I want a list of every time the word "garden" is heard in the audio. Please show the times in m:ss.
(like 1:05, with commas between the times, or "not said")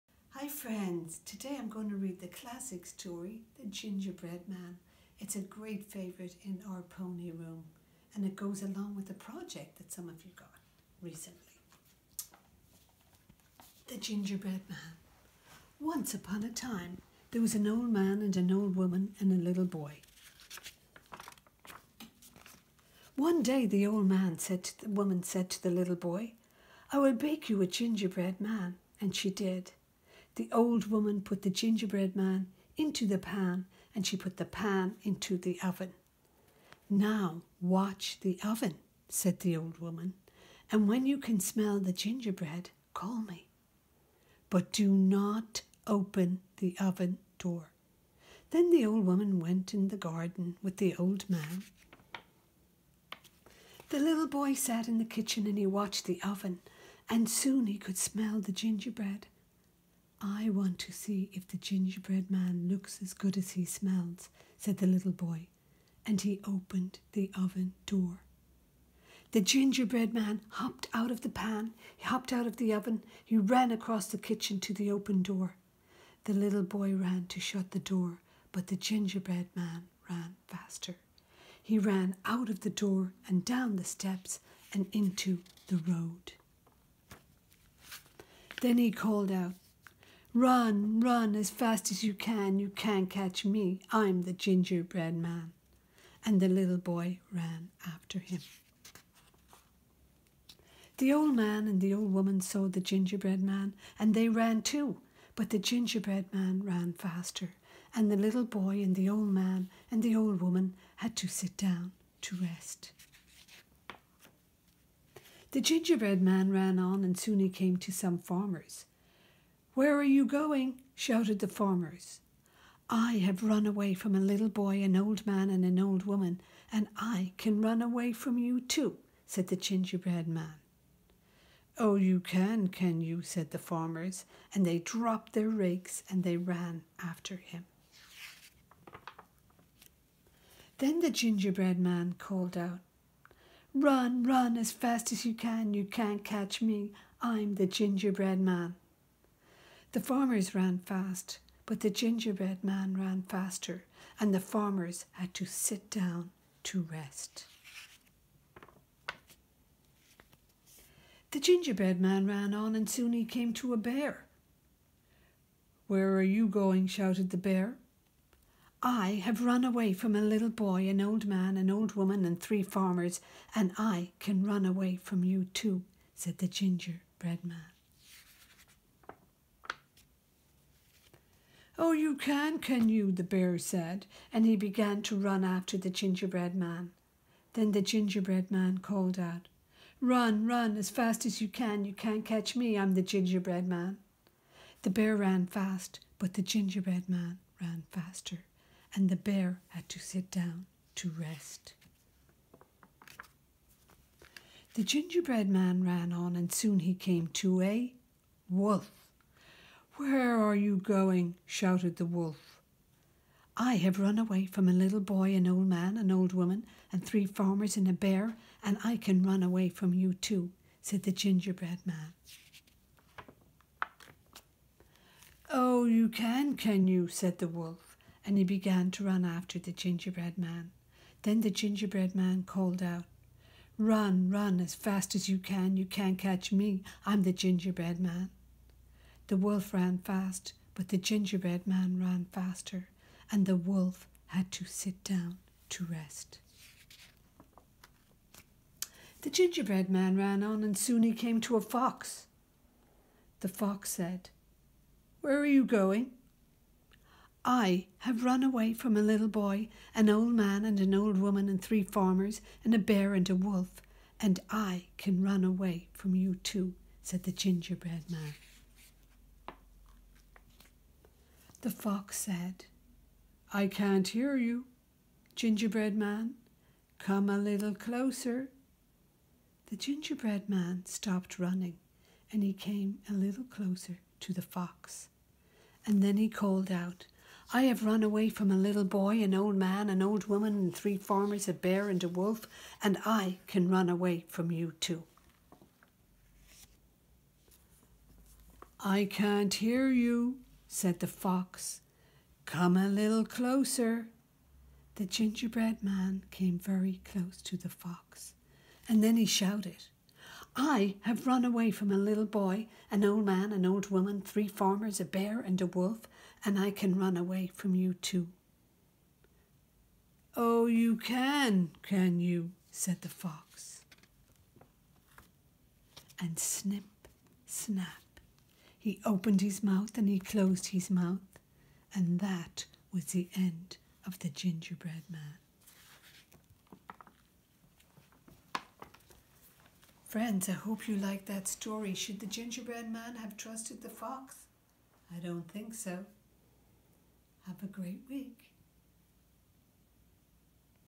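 0:49.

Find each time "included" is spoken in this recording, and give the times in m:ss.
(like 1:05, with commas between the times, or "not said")
not said.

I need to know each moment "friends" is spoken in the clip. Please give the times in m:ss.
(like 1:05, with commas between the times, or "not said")
0:00, 5:40.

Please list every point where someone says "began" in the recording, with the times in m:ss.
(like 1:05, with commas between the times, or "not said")
3:04, 3:48.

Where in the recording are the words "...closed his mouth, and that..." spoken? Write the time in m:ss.
5:30.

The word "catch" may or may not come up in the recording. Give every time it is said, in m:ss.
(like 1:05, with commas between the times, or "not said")
1:33, 2:26, 3:12, 3:56.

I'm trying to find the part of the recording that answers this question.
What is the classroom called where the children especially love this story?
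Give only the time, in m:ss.
0:06.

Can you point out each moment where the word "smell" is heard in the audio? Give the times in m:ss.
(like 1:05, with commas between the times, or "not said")
0:41, 0:57, 1:03.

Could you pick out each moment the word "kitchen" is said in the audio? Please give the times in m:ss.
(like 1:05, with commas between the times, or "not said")
0:55, 1:14.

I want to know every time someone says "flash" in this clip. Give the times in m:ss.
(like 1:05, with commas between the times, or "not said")
not said.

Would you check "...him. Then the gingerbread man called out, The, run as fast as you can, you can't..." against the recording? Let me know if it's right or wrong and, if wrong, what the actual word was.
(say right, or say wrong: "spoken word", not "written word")
wrong: "Run", not "The".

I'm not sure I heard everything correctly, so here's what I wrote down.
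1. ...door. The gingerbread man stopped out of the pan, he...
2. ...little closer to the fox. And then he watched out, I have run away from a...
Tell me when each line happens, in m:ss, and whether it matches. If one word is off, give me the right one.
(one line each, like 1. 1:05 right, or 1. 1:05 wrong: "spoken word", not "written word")
1. 1:07 wrong: "hopped", not "stopped"
2. 4:43 wrong: "called", not "watched".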